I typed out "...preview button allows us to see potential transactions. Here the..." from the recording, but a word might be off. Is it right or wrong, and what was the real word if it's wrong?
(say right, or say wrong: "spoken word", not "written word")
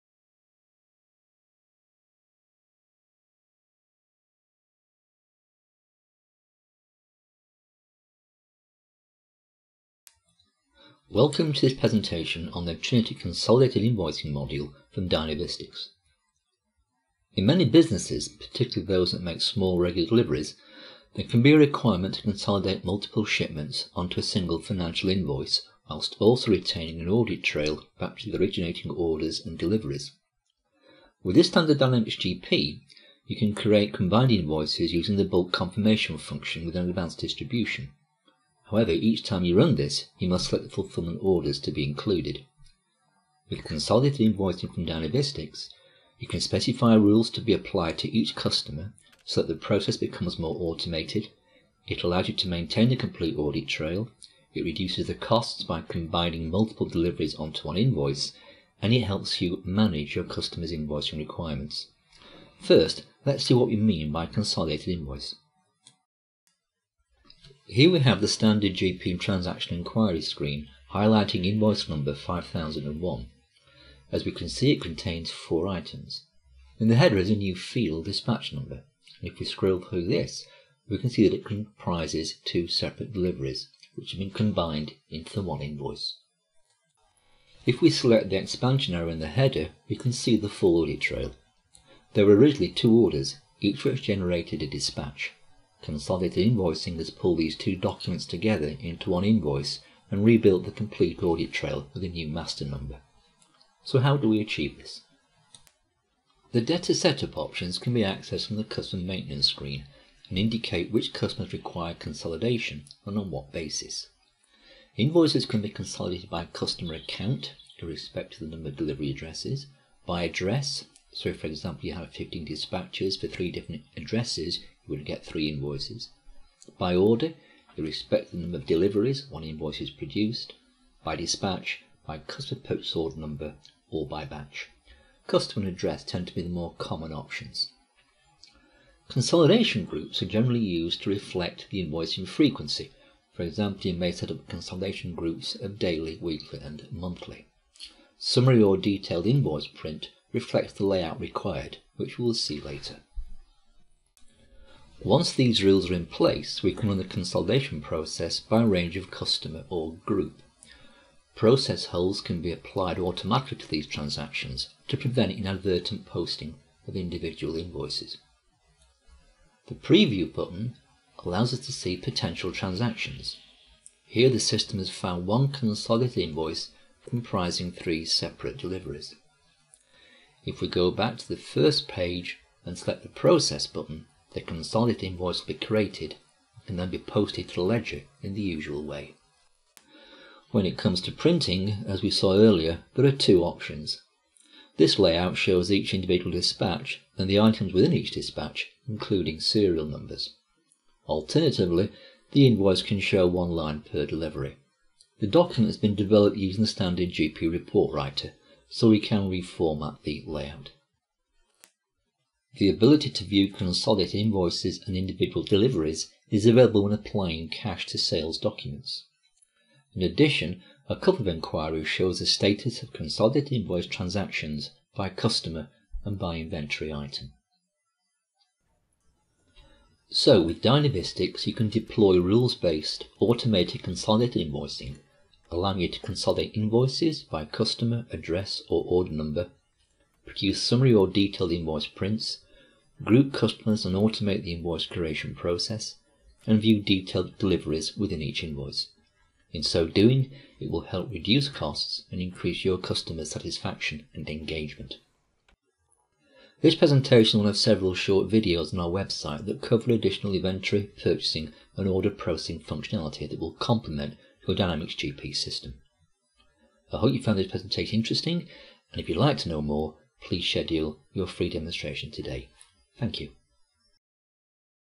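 right.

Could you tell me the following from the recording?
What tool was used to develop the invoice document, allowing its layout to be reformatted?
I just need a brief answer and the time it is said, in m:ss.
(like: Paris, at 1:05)
GP report writer, at 3:27.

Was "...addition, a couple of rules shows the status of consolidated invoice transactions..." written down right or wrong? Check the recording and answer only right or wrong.
wrong.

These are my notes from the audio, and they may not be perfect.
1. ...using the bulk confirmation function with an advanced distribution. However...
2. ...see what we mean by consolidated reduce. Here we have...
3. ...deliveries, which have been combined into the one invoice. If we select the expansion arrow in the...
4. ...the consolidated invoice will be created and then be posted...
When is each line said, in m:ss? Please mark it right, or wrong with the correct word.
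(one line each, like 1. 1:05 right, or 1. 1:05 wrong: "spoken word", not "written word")
1. 0:34 right
2. 1:03 wrong: "invoice", not "reduce"
3. 1:23 right
4. 3:04 right.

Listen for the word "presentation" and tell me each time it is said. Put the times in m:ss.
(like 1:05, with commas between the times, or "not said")
0:11, 4:16, 4:27.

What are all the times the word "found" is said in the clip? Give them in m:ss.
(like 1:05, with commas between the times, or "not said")
2:54, 4:27.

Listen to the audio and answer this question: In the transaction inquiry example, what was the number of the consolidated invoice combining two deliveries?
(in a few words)
5001.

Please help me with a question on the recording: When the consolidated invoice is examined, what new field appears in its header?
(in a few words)
Dispatch number.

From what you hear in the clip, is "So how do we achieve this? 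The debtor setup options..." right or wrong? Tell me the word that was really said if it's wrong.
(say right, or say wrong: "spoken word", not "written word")
right.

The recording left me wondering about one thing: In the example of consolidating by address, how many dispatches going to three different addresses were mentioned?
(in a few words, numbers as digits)
15.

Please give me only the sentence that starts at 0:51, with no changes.
It allows you to maintain the complete audit trail.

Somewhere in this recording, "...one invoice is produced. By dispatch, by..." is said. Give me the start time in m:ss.
2:09.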